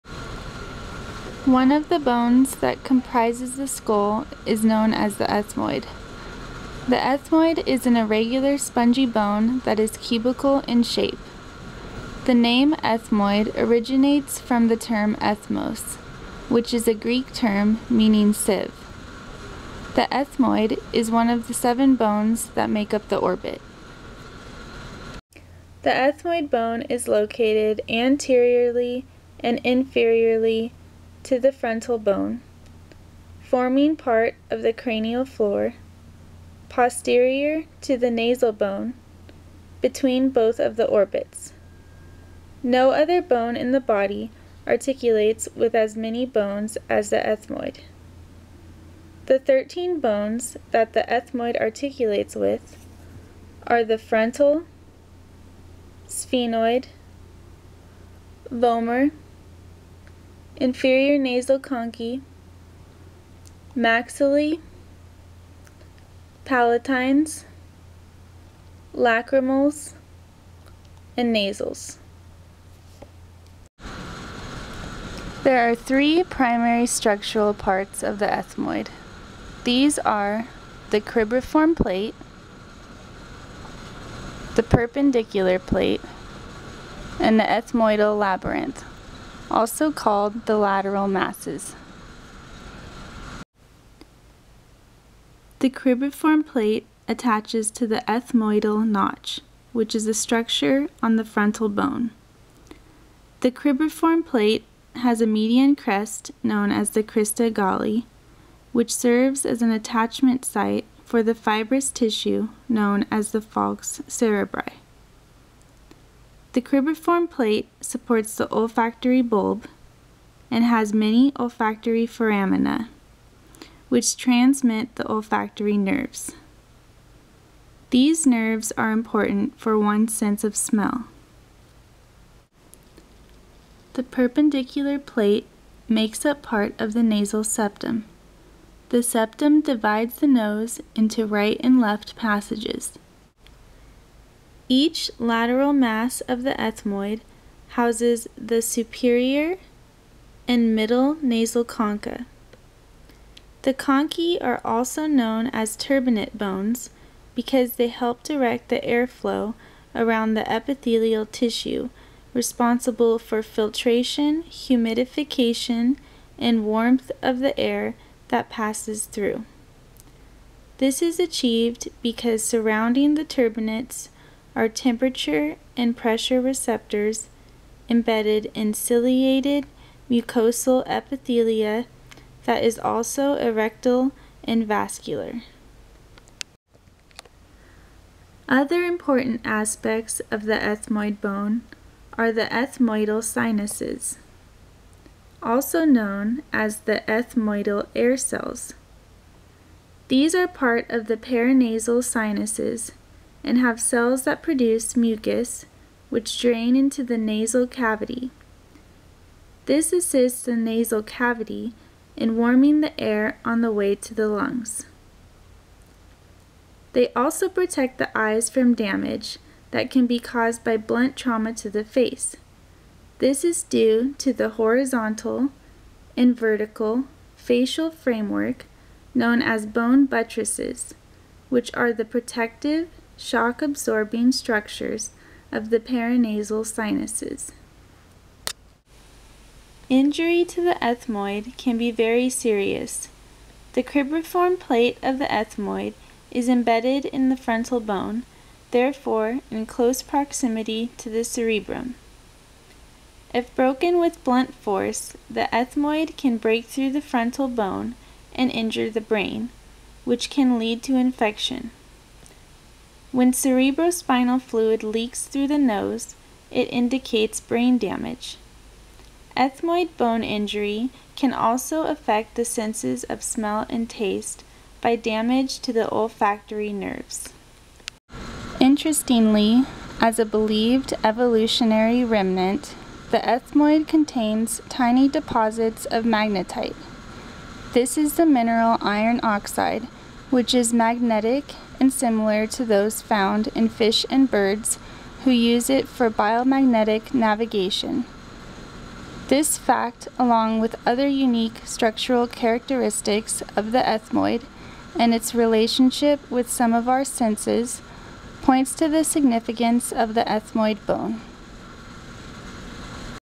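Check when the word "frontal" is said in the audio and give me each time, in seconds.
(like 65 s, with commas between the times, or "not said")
31 s, 53 s, 101 s, 247 s, 257 s.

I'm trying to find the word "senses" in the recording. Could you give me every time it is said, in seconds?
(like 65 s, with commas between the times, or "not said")
130 s, 272 s, 307 s.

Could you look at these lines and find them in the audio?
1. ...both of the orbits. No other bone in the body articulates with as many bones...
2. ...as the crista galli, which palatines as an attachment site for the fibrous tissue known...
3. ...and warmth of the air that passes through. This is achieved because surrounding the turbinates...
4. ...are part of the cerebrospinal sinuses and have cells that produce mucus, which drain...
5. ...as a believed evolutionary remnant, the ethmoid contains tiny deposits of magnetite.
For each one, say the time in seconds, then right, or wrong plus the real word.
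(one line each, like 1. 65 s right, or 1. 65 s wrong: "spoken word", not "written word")
1. 40 s right
2. 106 s wrong: "serves", not "palatines"
3. 166 s right
4. 200 s wrong: "paranasal", not "cerebrospinal"
5. 279 s right.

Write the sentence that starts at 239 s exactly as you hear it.
Injury to the ethmoid can be very serious.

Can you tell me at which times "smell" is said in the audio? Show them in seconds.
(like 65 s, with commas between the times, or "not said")
130 s, 273 s.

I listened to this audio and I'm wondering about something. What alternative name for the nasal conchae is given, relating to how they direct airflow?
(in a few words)
turbinate bones.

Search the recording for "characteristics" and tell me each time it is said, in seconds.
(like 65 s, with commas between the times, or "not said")
302 s.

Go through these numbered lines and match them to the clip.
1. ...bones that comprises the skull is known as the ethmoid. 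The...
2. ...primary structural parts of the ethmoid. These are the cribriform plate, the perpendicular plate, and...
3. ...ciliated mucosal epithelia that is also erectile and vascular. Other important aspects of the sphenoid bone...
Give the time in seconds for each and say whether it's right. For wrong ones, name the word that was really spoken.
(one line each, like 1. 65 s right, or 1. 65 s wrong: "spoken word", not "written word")
1. 1 s right
2. 76 s right
3. 178 s wrong: "ethmoid", not "sphenoid".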